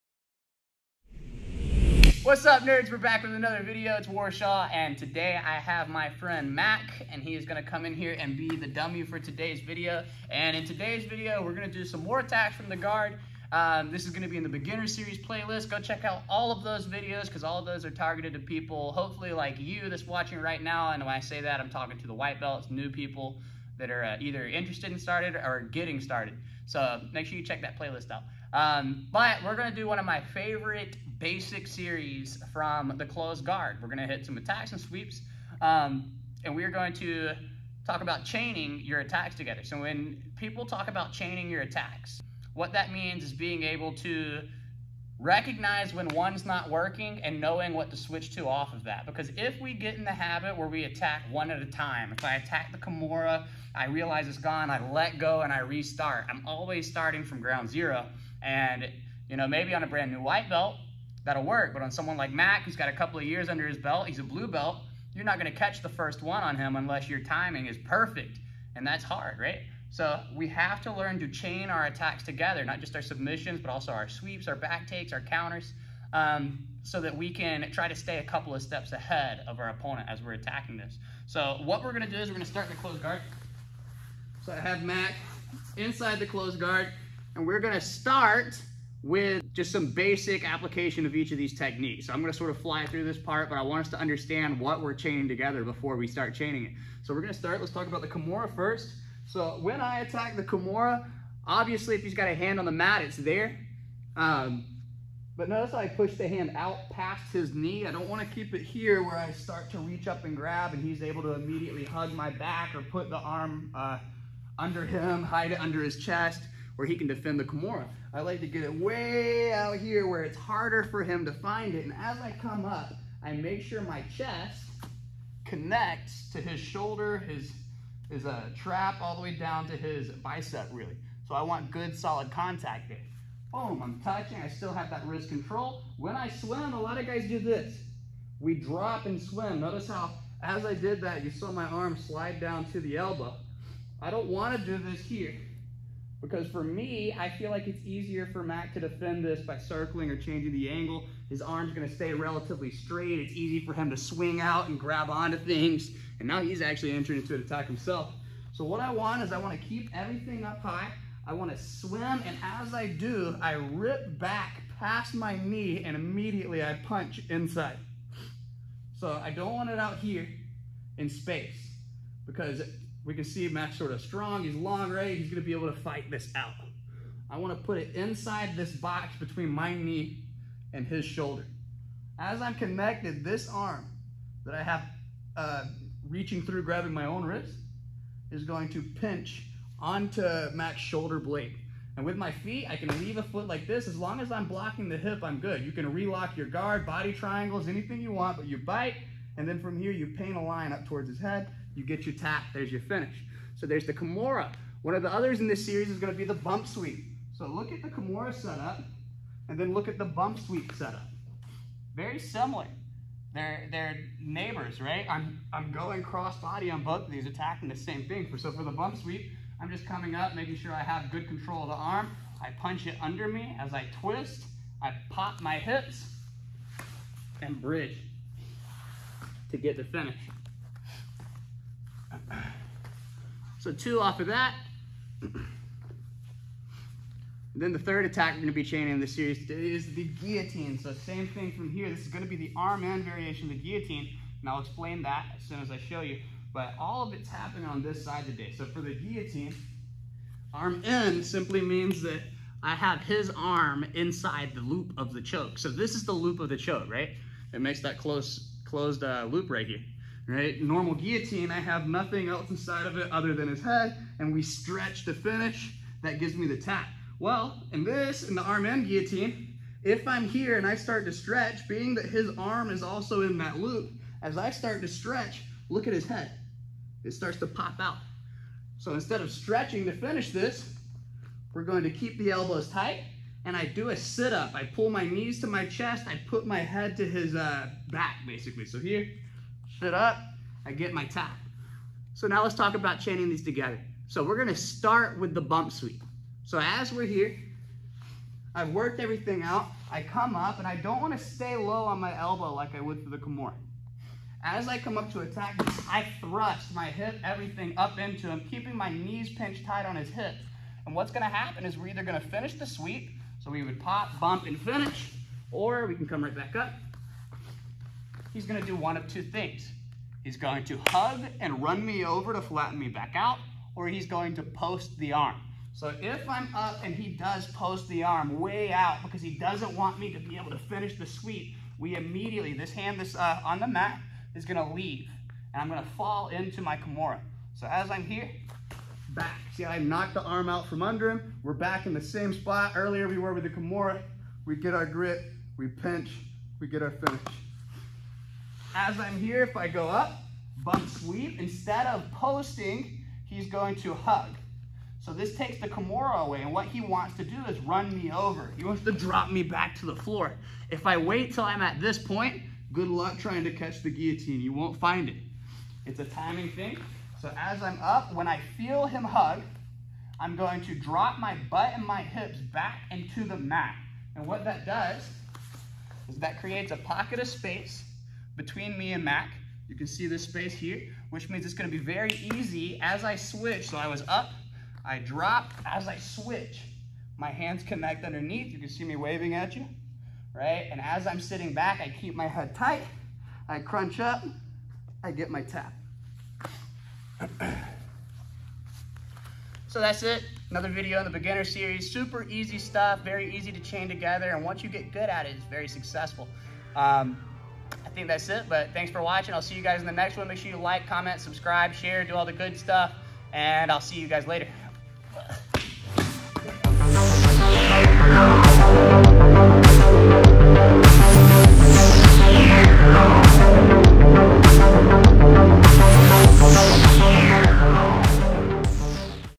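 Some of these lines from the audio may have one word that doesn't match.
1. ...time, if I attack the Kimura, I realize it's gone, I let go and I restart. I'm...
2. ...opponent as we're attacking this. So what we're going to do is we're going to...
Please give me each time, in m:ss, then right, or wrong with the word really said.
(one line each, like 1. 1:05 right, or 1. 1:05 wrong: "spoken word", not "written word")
1. 0:51 right
2. 1:19 right.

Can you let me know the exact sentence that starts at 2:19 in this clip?
Notice how as I did that, you saw my arm slide down to the elbow.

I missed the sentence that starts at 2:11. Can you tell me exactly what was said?
So I want good, solid contact there.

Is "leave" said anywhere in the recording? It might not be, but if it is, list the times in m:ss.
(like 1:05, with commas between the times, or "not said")
3:12, 5:34.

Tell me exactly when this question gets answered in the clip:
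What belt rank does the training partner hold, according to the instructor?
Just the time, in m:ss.
1:04.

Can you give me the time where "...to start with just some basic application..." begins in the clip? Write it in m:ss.
1:27.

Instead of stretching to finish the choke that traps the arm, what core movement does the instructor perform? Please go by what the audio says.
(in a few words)
a sit-up.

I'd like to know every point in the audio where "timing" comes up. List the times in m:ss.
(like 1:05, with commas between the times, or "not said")
1:07, 6:06.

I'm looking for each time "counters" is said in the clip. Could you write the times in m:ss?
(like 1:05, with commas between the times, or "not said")
1:15.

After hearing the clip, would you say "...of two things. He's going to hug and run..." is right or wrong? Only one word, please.
right.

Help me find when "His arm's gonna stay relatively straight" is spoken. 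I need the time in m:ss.
2:31.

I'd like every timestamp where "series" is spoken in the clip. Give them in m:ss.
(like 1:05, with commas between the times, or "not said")
0:14, 0:31, 3:25, 3:59, 6:41.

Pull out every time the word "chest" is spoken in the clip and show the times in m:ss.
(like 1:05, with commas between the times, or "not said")
1:55, 2:04, 4:45.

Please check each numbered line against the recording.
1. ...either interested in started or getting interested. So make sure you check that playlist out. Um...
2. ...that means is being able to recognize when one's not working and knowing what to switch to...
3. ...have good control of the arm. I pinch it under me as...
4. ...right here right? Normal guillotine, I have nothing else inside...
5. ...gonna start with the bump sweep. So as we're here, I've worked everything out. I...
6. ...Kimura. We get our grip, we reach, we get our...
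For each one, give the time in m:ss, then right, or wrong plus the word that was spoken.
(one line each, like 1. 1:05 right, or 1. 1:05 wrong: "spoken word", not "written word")
1. 0:24 wrong: "started", not "interested"
2. 0:42 right
3. 3:40 wrong: "punch", not "pinch"
4. 4:19 right
5. 4:54 right
6. 5:43 wrong: "pinch", not "reach".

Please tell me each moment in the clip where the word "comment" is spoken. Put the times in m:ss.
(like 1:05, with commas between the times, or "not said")
6:50.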